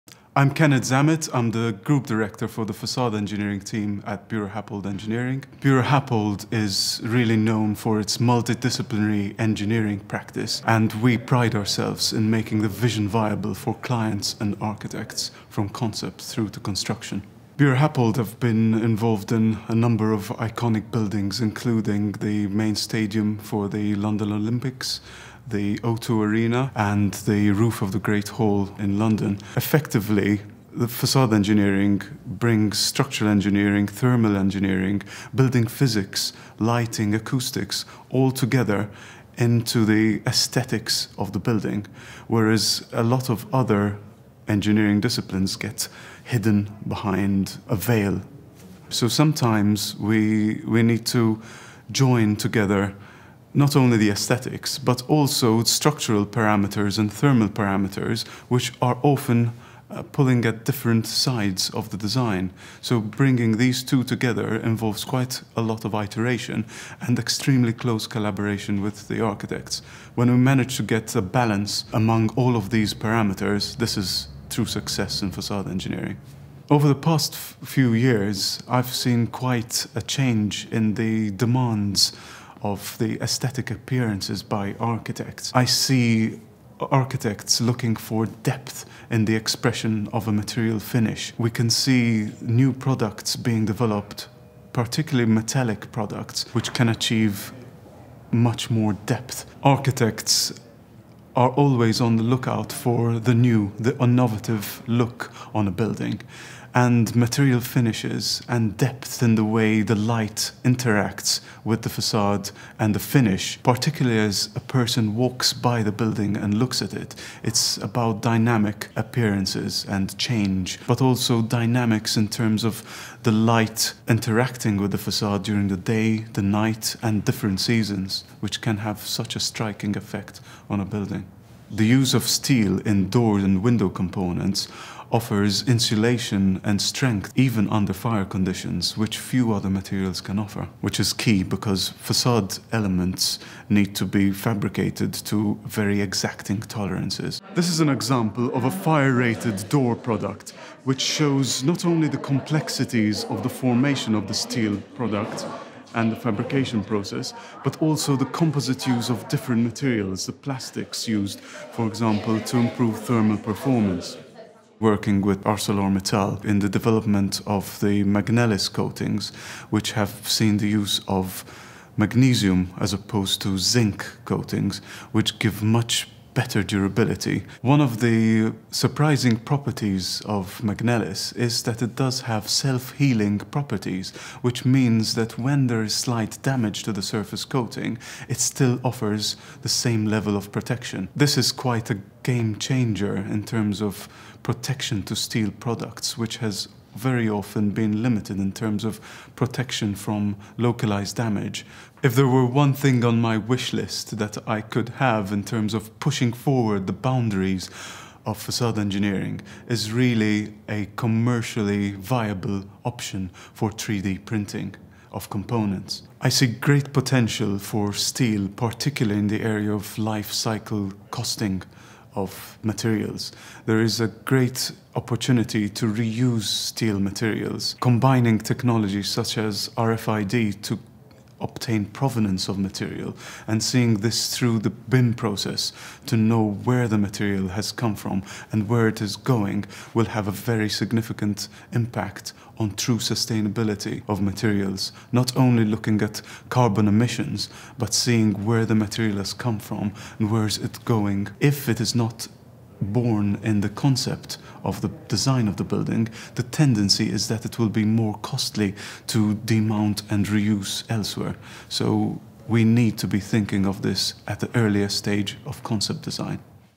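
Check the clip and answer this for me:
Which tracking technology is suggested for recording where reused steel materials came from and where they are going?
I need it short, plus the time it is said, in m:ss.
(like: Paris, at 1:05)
RFID, at 3:49.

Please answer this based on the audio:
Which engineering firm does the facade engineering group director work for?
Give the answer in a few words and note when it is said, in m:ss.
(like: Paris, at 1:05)
BuroHappold Engineering, at 0:04.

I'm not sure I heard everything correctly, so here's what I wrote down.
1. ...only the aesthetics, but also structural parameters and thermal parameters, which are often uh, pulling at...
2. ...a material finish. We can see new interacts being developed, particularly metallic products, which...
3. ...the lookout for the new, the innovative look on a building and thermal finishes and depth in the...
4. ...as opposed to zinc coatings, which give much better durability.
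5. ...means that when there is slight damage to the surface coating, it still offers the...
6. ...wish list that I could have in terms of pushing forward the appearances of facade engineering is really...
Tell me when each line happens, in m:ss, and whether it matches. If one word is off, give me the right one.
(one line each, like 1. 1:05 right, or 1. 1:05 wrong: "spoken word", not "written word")
1. 0:53 right
2. 1:30 wrong: "products", not "interacts"
3. 1:42 wrong: "material", not "thermal"
4. 2:52 right
5. 3:04 right
6. 3:23 wrong: "boundaries", not "appearances".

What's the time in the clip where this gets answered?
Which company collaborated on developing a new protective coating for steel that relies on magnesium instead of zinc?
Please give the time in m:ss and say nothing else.
2:45.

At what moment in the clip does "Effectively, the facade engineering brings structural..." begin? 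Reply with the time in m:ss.
0:29.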